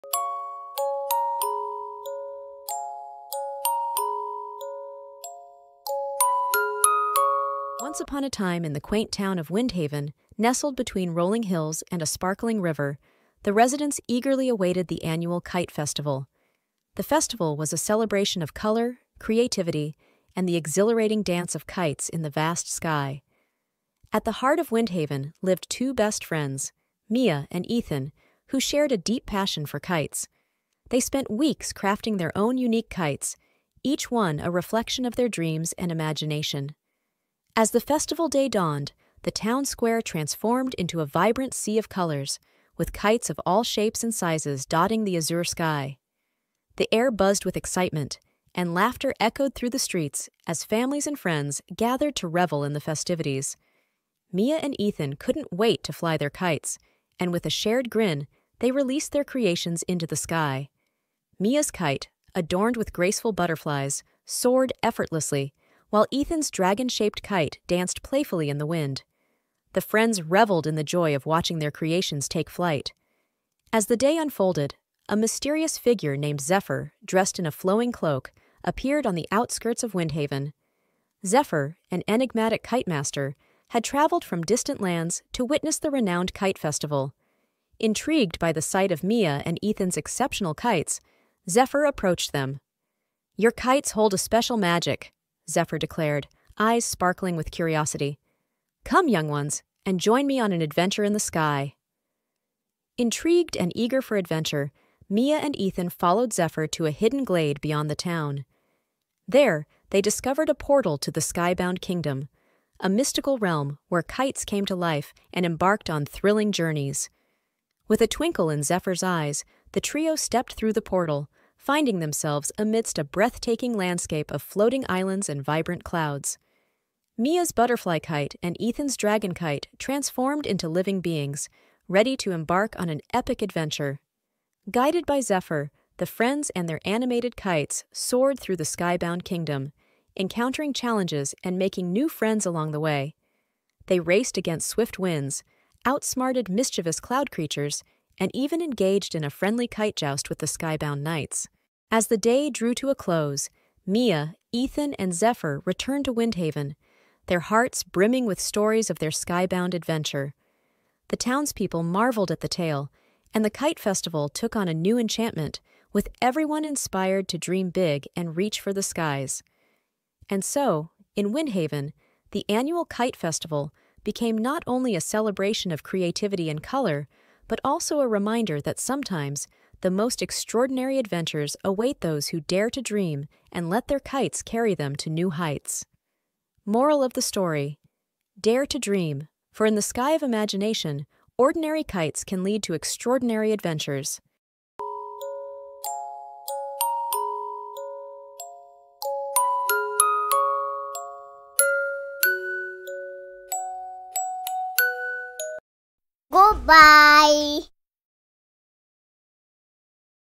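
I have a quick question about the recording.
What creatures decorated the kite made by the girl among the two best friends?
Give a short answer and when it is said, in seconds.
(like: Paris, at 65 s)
Butterflies, at 63 s.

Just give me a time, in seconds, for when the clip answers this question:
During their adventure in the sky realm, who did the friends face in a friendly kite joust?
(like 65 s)
150 s.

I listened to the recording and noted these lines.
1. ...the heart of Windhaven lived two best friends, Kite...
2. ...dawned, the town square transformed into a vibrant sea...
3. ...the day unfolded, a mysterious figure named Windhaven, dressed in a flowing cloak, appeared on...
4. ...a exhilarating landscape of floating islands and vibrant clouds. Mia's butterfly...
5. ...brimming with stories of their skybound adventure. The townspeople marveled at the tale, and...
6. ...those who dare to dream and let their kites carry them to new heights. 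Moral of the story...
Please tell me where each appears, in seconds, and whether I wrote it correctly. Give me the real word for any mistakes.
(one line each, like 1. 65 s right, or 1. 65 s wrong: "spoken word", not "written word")
1. 24 s wrong: "Mia", not "Kite"
2. 38 s right
3. 73 s wrong: "Zephyr", not "Windhaven"
4. 122 s wrong: "breathtaking", not "exhilarating"
5. 157 s right
6. 181 s right.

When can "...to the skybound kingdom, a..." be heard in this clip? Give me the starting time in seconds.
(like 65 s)
110 s.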